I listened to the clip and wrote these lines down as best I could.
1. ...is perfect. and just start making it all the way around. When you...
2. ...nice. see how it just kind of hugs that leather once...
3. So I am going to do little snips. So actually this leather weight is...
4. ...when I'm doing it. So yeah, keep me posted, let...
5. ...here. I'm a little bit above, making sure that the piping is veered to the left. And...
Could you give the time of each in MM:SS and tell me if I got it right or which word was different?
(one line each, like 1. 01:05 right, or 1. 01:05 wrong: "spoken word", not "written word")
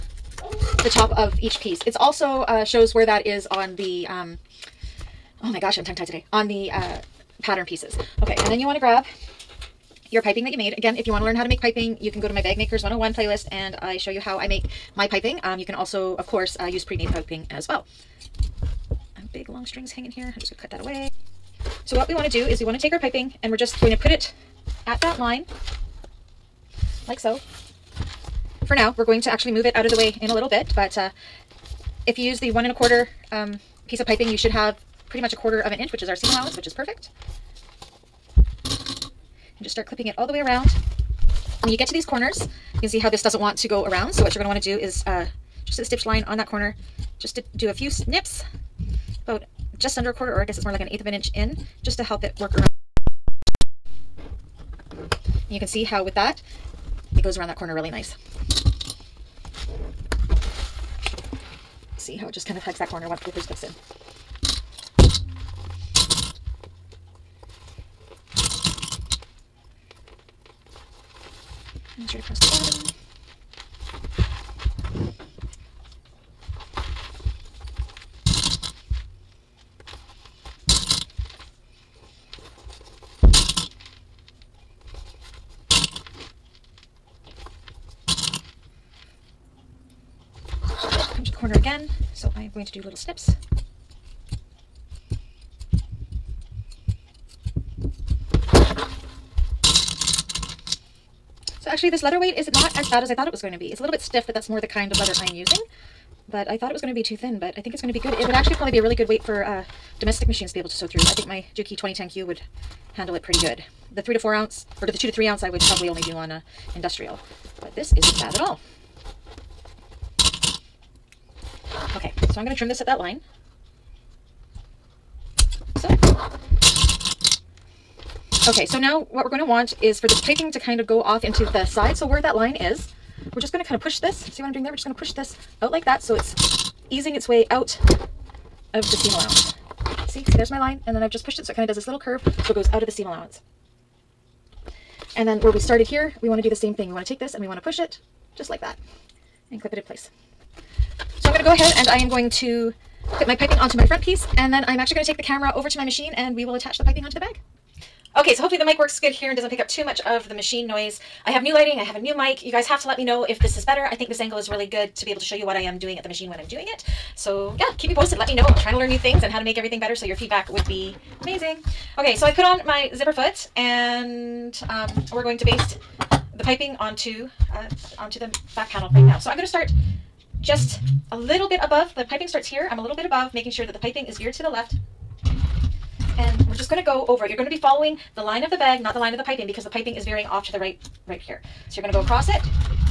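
1. 00:36 wrong: "clipping", not "making"
2. 00:57 wrong: "corner", not "leather"
3. 01:32 right
4. 02:46 right
5. 03:02 right.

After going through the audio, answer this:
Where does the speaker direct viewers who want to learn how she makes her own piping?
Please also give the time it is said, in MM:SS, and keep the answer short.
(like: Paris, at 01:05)
Bag Makers 101 playlist, at 00:12.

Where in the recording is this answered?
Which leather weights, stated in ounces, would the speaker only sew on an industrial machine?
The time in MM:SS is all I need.
01:54.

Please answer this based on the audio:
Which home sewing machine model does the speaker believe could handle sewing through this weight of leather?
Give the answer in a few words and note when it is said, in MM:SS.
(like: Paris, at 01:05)
Juki 2010Q, at 01:51.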